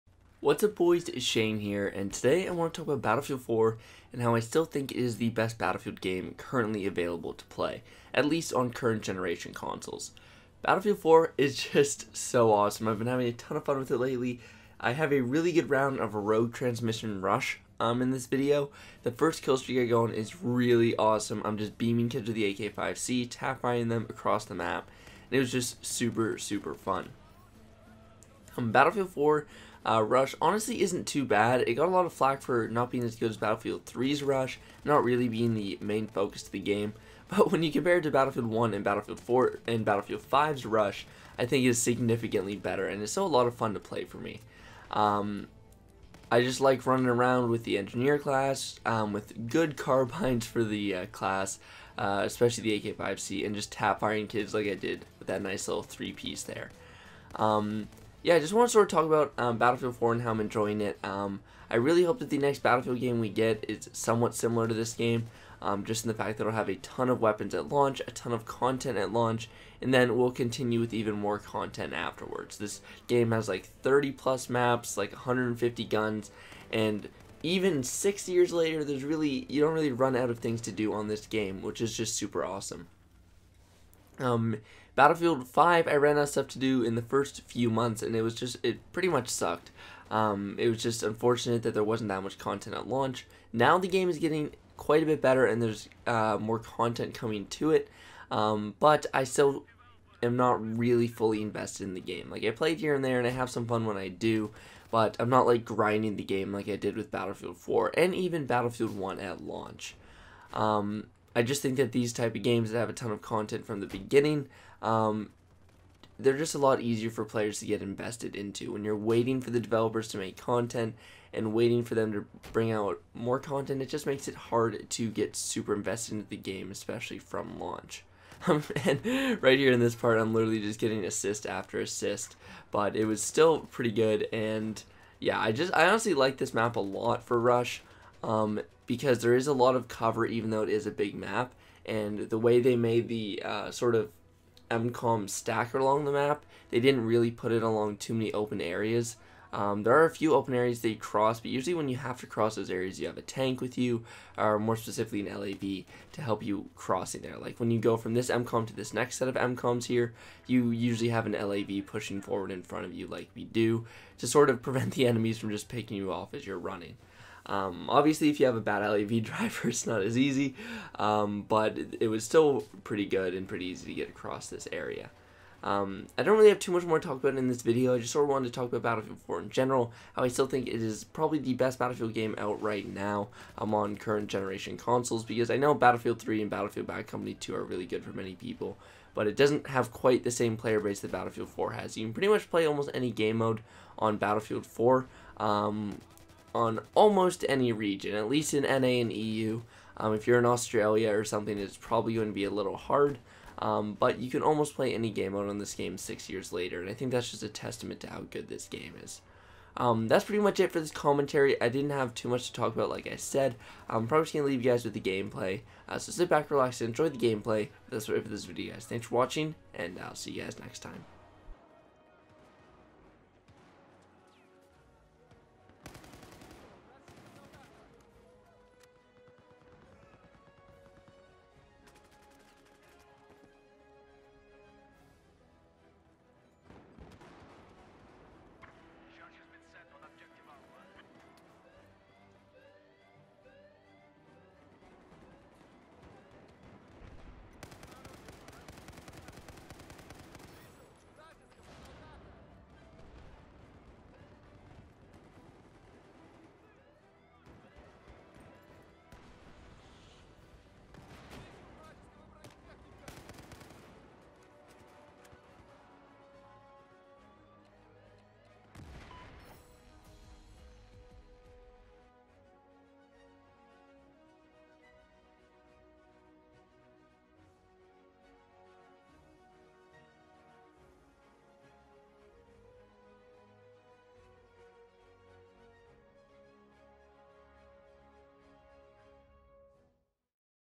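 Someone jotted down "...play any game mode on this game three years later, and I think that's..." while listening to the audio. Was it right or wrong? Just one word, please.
wrong.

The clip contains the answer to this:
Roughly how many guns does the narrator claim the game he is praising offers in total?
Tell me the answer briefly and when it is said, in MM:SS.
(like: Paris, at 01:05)
150, at 01:15.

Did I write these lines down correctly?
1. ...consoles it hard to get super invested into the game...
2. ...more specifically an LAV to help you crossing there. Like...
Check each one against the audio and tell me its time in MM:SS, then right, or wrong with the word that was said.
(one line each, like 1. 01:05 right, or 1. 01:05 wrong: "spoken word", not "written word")
1. 02:04 wrong: "makes", not "consoles"
2. 02:34 right.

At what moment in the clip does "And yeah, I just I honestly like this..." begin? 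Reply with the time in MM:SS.
02:14.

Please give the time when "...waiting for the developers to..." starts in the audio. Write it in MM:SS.
01:58.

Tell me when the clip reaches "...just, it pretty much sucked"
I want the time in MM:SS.
01:28.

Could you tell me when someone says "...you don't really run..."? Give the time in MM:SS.
01:19.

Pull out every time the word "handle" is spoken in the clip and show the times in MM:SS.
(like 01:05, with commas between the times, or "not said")
not said.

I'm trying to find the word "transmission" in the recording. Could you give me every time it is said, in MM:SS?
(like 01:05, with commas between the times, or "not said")
00:16.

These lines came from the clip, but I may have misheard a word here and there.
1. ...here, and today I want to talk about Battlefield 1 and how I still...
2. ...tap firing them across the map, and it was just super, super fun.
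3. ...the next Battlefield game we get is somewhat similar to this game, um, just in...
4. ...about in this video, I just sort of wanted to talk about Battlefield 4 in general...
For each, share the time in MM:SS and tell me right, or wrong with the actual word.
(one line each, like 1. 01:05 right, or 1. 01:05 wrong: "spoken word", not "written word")
1. 00:01 wrong: "4", not "1"
2. 00:23 right
3. 01:02 right
4. 02:57 right.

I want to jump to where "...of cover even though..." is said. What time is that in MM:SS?
02:19.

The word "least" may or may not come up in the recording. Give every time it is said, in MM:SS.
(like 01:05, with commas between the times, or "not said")
00:08, 03:18.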